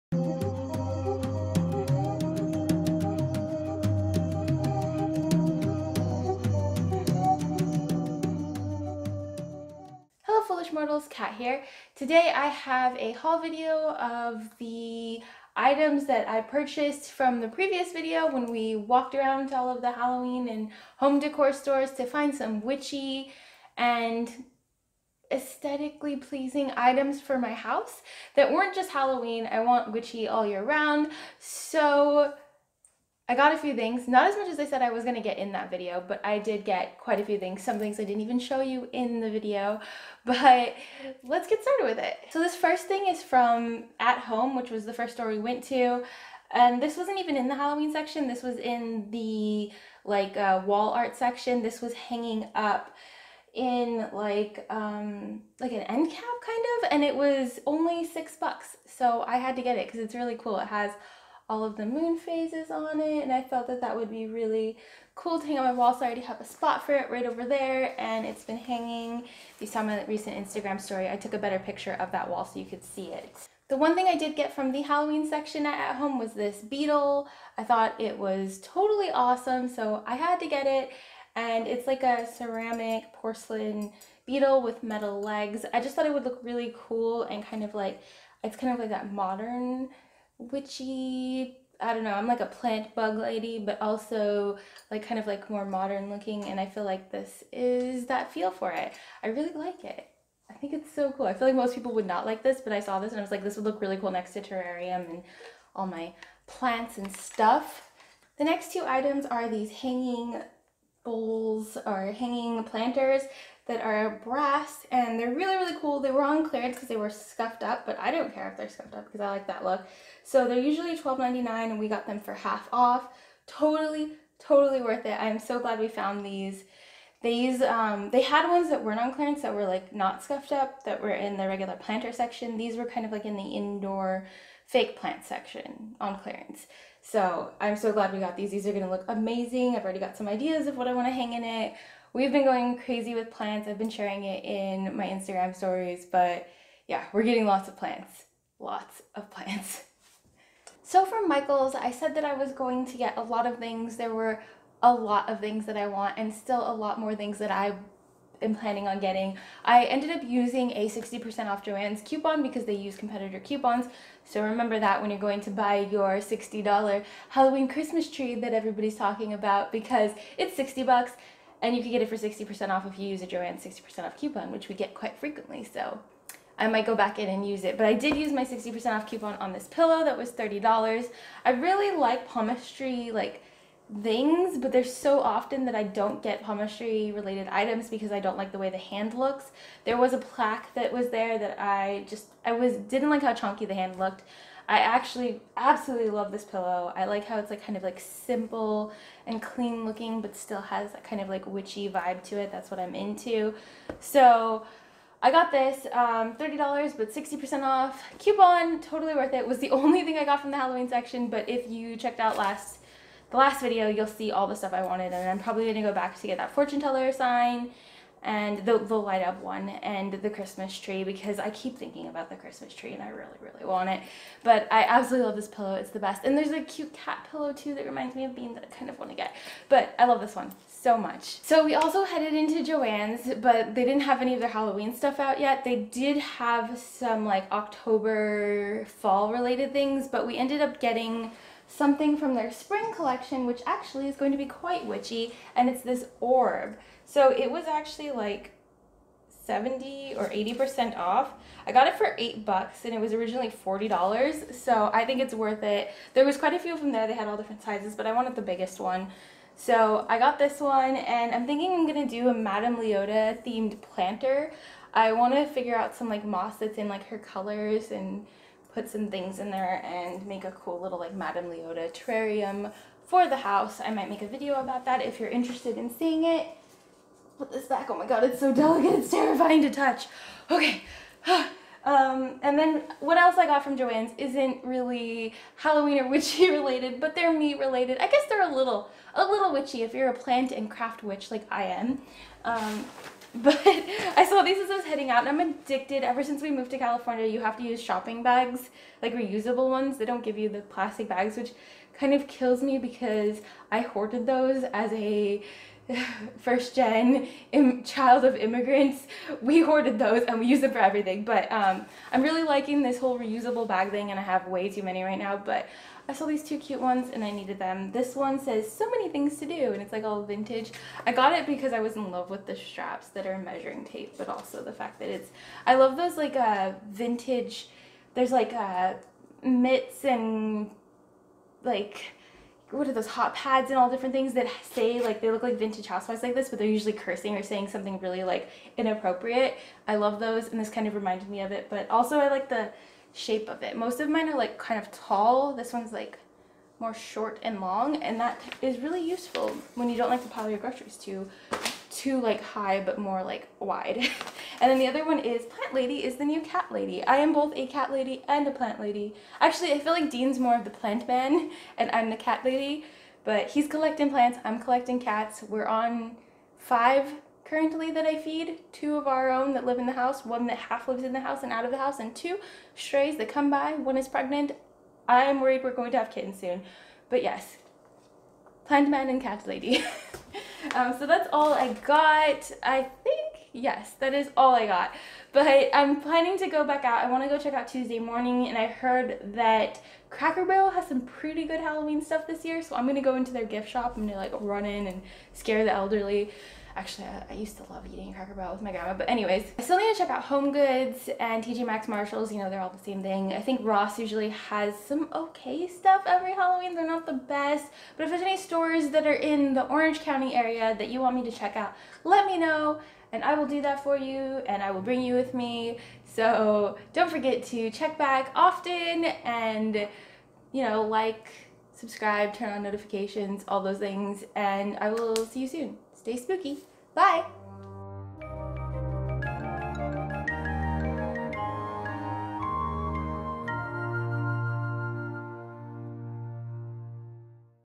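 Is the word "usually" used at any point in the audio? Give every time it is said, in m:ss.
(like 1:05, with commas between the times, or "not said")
2:00, 5:36, 6:43.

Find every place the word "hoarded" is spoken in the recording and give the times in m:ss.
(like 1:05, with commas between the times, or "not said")
5:03, 5:09.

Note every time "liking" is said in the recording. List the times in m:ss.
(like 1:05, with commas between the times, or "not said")
5:12.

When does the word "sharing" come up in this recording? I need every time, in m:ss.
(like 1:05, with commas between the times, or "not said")
2:23.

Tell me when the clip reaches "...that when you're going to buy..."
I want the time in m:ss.
2:44.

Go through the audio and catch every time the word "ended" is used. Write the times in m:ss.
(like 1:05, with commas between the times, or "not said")
2:39, 4:00.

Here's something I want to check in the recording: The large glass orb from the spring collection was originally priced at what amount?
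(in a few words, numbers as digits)
$40.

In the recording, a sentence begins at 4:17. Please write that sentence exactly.
They had all different sizes, but I wanted the biggest one.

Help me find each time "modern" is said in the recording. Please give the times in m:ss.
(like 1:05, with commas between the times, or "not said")
1:29, 1:35.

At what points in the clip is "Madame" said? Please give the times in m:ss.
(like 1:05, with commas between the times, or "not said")
4:22, 4:31.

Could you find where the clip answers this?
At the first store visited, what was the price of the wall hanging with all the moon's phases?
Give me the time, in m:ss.
0:58.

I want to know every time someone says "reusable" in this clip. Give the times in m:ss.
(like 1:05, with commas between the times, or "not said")
4:59, 5:13.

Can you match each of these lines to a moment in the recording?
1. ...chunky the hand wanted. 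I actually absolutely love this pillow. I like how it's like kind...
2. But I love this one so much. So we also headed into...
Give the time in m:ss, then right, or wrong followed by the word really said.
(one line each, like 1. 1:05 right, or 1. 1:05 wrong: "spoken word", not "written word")
1. 3:13 wrong: "looked", not "wanted"
2. 3:49 right.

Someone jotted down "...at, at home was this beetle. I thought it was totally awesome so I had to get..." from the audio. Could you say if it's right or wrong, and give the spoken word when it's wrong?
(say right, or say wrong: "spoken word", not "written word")
right.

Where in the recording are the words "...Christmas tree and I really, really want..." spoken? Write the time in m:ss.
3:42.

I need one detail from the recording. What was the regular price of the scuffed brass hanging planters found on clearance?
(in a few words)
$12.99.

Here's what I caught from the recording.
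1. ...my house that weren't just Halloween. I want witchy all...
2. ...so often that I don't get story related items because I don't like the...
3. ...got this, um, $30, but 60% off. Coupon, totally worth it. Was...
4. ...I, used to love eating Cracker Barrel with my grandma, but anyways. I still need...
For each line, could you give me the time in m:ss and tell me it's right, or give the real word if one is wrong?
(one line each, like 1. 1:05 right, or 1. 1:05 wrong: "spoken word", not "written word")
1. 0:27 right
2. 3:04 wrong: "palmistry", not "story"
3. 3:25 right
4. 6:37 right.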